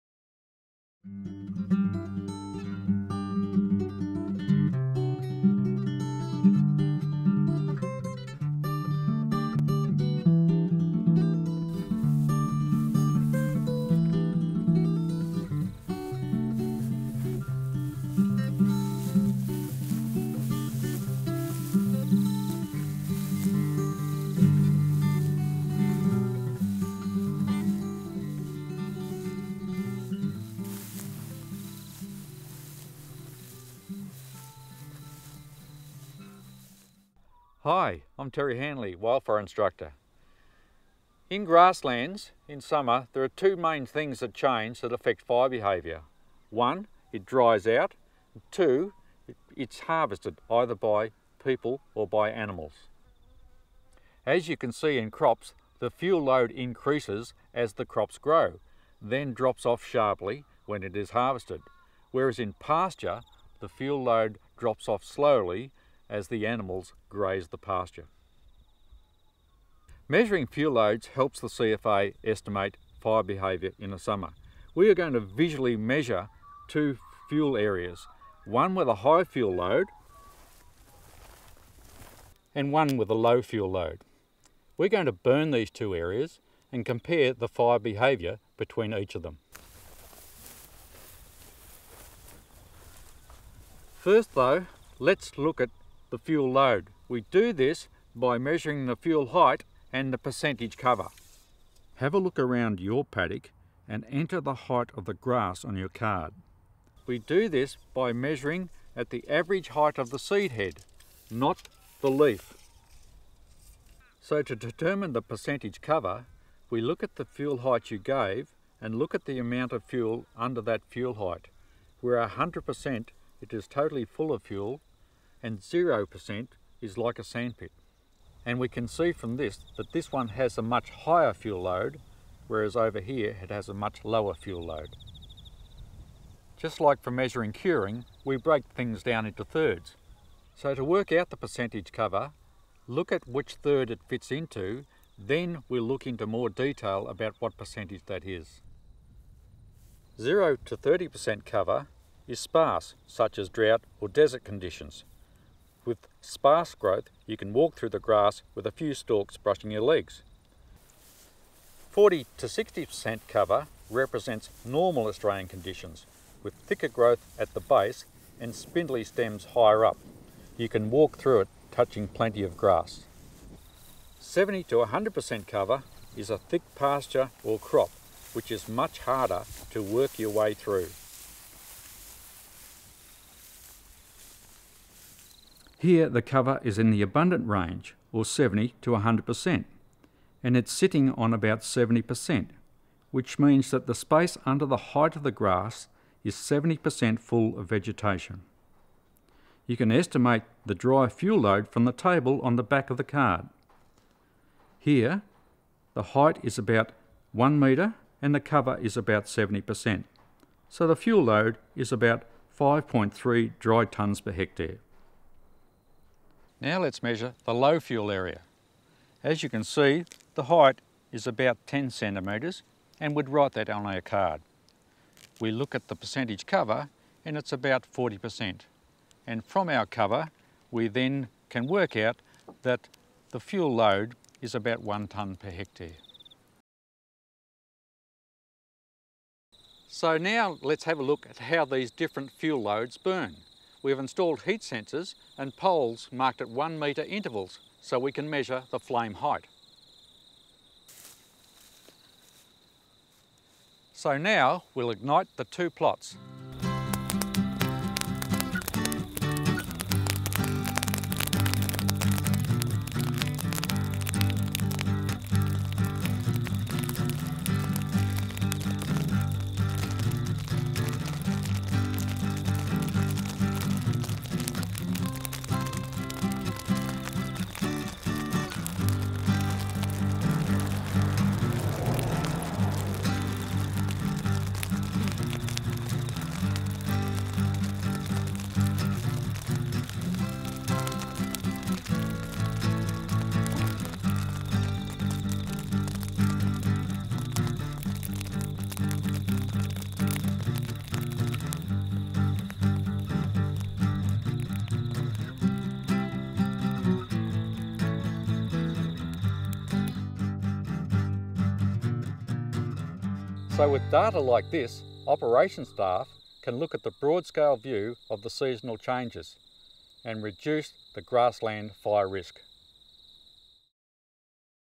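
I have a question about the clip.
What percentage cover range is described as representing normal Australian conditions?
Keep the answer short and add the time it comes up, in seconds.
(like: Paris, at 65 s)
40 to 60%, at 161 s.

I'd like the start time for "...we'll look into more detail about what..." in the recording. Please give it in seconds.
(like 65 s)
145 s.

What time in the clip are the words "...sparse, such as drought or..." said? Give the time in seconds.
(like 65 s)
152 s.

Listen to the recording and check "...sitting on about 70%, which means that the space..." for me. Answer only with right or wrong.
right.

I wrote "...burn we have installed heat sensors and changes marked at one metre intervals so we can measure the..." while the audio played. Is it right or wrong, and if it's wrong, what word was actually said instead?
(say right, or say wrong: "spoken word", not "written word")
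wrong: "poles", not "changes".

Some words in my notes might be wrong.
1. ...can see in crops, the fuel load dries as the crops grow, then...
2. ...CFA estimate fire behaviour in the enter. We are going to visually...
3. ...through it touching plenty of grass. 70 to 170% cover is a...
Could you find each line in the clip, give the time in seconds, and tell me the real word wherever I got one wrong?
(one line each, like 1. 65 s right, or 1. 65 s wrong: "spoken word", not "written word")
1. 54 s wrong: "increases", not "dries"
2. 71 s wrong: "summer", not "enter"
3. 171 s wrong: "100", not "170".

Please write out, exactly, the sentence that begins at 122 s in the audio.
Where 100% it is totally full of fuel and 0% is like a sandpit.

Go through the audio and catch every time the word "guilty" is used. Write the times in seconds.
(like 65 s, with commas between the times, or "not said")
not said.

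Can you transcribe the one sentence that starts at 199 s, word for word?
You can estimate the dry fuel load from the table on the back of the card.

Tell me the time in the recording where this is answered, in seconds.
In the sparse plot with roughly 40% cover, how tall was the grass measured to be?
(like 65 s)
221 s.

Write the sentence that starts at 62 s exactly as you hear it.
Whereas in pasture, the fuel load drops off slowly as the animals graze the pasture.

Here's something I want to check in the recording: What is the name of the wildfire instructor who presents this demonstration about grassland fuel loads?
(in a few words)
Terry Hanley.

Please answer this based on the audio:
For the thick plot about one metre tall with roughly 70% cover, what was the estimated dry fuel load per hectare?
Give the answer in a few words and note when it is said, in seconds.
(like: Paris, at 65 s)
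5.3 tonnes, at 212 s.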